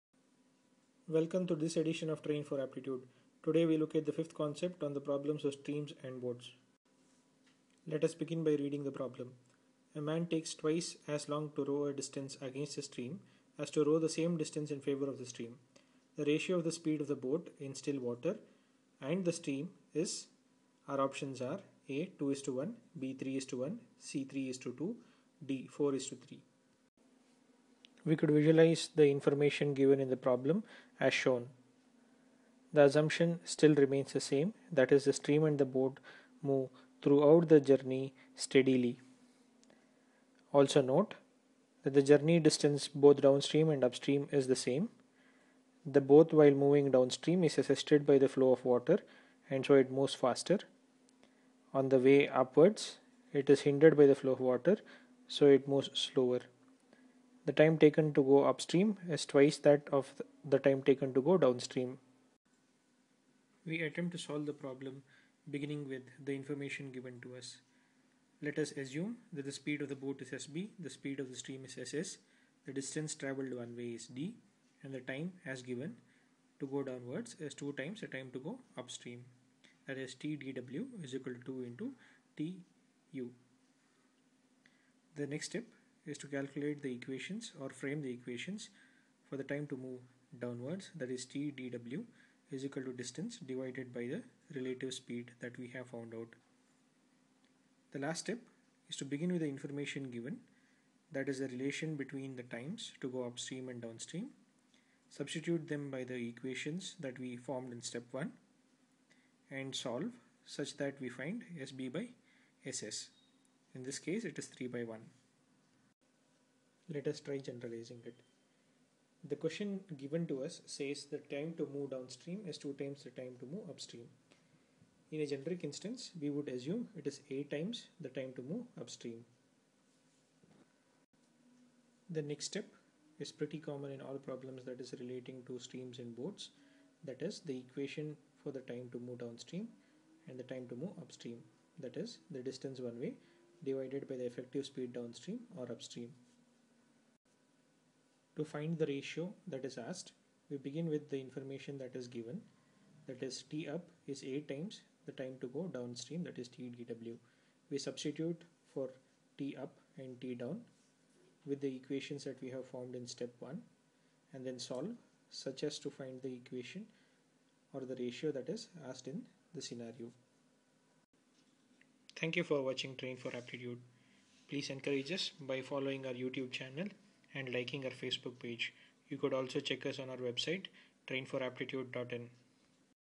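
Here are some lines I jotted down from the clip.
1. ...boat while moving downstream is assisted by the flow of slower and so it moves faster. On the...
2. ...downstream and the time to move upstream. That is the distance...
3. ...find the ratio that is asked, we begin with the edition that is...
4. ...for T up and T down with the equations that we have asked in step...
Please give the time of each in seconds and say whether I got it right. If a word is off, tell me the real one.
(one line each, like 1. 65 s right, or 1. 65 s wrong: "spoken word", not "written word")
1. 46 s wrong: "water", not "slower"
2. 139 s right
3. 148 s wrong: "information", not "edition"
4. 158 s wrong: "formed", not "asked".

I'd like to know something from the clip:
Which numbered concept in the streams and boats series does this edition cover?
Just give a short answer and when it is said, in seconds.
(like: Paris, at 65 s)
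fifth, at 4 s.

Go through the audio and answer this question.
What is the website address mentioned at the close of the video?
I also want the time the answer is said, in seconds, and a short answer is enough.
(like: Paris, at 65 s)
trainforaptitude.in, at 181 s.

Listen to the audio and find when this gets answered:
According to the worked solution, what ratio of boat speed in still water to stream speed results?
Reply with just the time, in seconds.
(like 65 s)
114 s.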